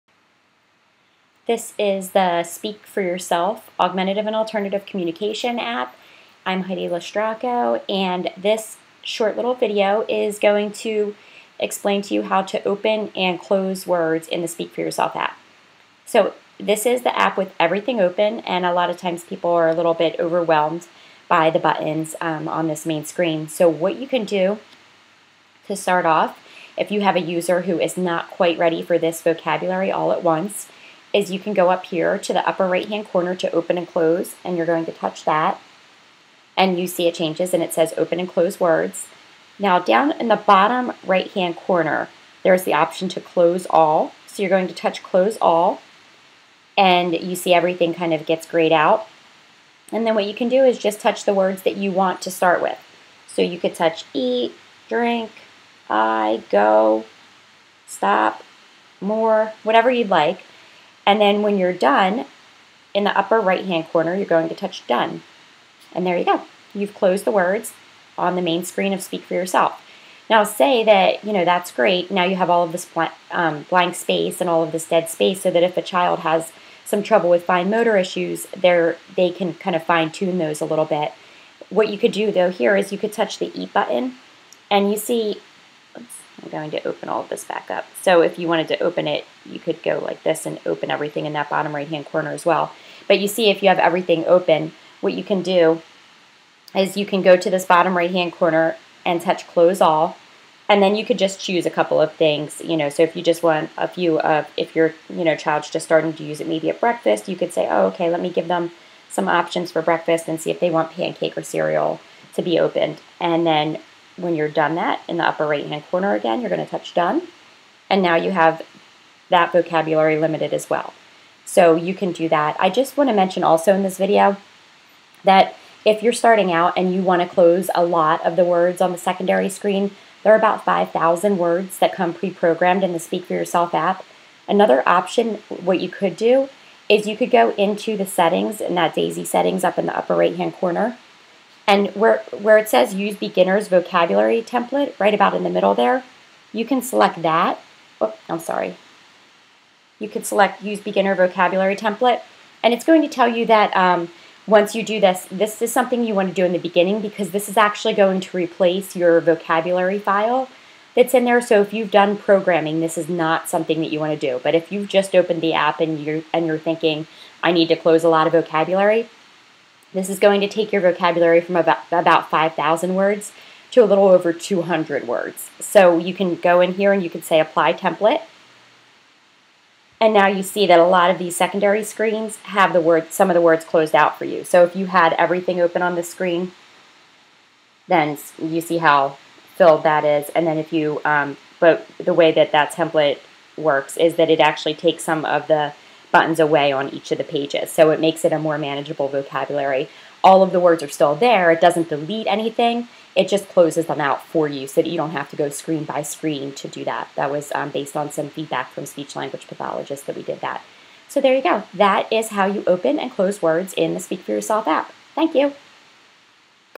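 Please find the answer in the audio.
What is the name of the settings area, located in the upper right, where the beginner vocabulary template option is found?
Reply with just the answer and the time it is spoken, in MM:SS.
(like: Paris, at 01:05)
DAISY settings, at 02:18.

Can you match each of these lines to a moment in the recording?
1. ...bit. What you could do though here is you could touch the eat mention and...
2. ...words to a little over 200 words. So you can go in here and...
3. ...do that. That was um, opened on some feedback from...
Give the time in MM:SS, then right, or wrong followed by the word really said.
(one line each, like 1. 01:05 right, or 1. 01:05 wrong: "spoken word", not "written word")
1. 01:20 wrong: "button", not "mention"
2. 02:52 right
3. 03:26 wrong: "based", not "opened".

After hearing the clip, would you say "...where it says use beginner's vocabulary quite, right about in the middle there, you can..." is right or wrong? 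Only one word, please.
wrong.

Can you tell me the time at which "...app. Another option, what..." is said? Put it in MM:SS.
02:13.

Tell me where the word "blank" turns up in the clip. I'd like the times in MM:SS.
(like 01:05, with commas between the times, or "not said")
01:13.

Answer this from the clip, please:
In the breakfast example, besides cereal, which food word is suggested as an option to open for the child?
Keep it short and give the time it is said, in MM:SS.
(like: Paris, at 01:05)
Pancake, at 01:50.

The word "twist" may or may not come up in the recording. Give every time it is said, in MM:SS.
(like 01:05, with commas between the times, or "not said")
not said.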